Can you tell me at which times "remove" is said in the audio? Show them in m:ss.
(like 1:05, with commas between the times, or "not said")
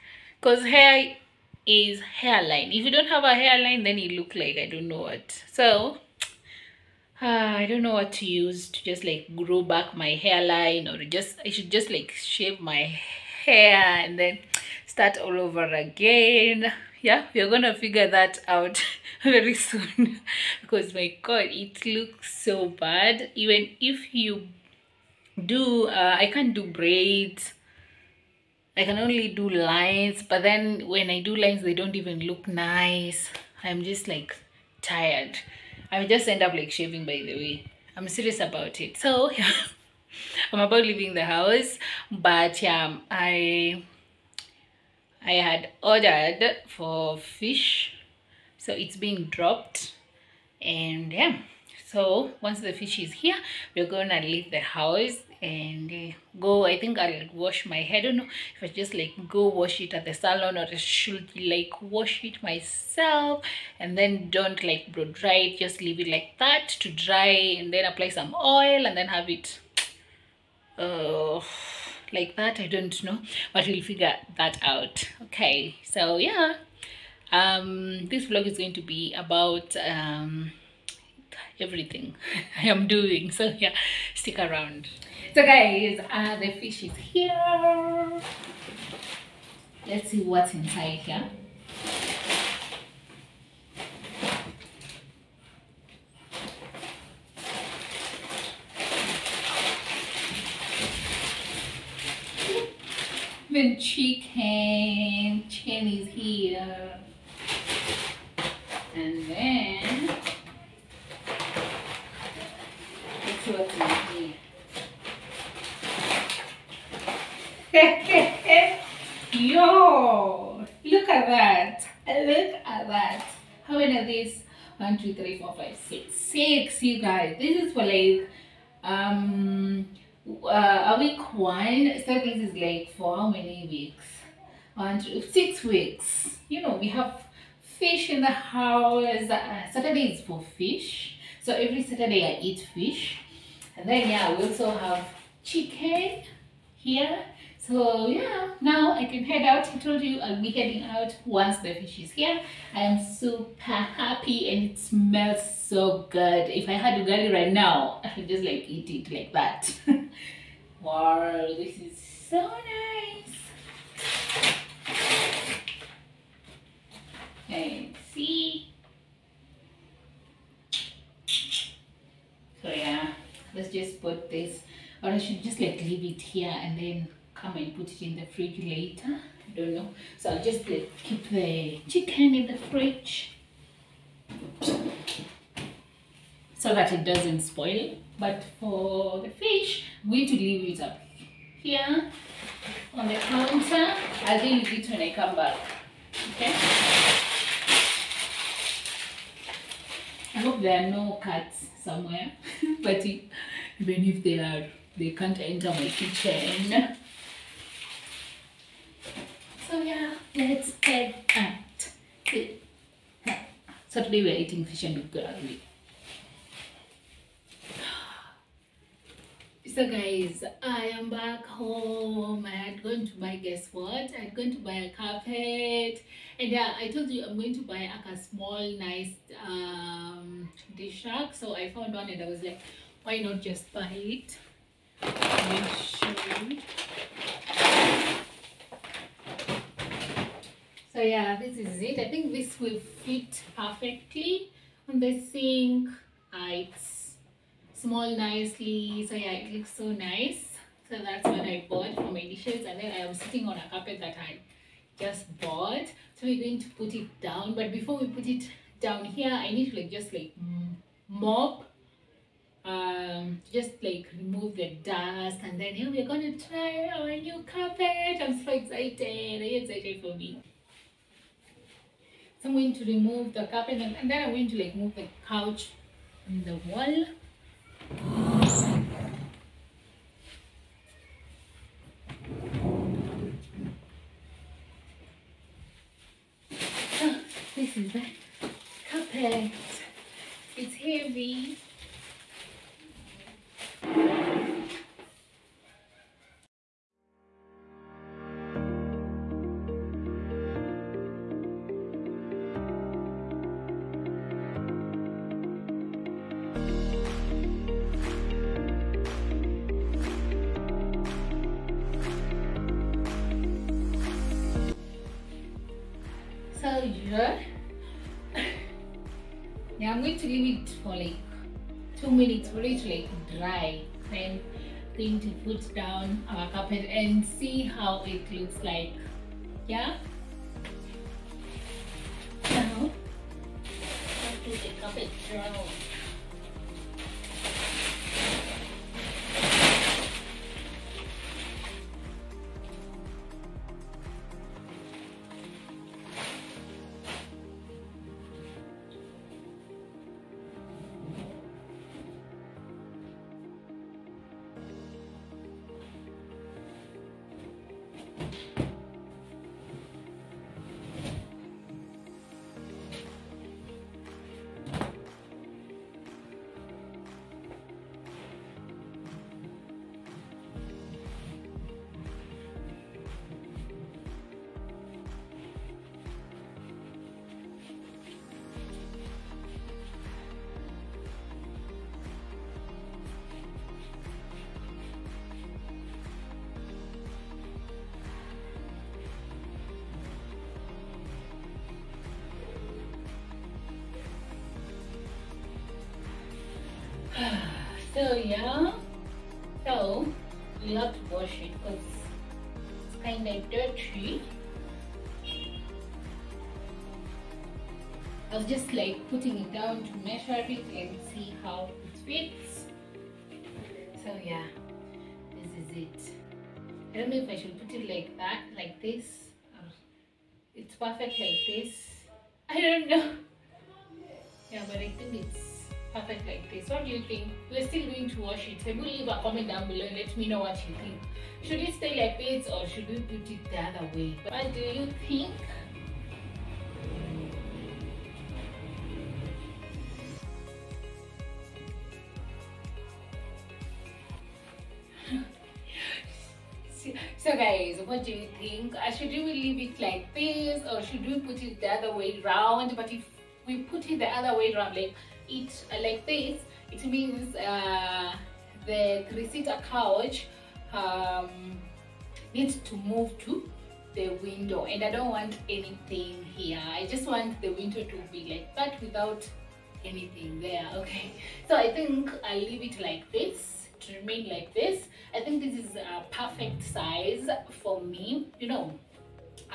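4:24, 4:32.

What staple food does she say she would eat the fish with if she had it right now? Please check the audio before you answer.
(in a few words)
Ugali.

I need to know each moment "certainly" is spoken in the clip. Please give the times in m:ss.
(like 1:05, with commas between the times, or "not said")
not said.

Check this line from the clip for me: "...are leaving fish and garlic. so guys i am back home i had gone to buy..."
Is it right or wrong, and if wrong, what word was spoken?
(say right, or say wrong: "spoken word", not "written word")
wrong: "eating", not "leaving".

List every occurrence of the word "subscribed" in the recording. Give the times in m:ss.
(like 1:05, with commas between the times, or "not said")
not said.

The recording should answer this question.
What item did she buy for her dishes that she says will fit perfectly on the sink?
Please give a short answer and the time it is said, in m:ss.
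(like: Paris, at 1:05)
Dish rack, at 3:50.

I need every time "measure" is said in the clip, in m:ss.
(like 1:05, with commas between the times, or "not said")
6:49.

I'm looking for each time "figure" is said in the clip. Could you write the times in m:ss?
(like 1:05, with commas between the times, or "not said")
0:17, 1:13.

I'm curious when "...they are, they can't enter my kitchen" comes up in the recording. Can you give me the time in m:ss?
3:24.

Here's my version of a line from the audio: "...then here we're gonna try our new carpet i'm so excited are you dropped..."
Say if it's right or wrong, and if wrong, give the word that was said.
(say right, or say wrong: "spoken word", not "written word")
wrong: "excited", not "dropped".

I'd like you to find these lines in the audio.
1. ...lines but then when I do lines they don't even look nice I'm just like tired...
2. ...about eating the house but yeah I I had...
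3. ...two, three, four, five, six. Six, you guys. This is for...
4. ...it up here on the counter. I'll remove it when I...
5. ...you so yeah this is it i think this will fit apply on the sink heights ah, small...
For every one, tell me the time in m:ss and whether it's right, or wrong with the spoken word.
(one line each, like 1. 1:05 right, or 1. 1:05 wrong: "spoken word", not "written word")
1. 0:29 right
2. 0:40 wrong: "leaving", not "eating"
3. 2:04 right
4. 3:10 wrong: "leave", not "remove"
5. 3:56 wrong: "perfectly", not "apply".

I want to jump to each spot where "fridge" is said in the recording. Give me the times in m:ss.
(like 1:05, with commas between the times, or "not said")
2:58, 3:02.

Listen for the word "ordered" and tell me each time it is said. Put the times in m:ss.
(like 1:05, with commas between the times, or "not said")
0:45.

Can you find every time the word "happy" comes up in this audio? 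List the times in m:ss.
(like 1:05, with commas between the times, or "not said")
2:33.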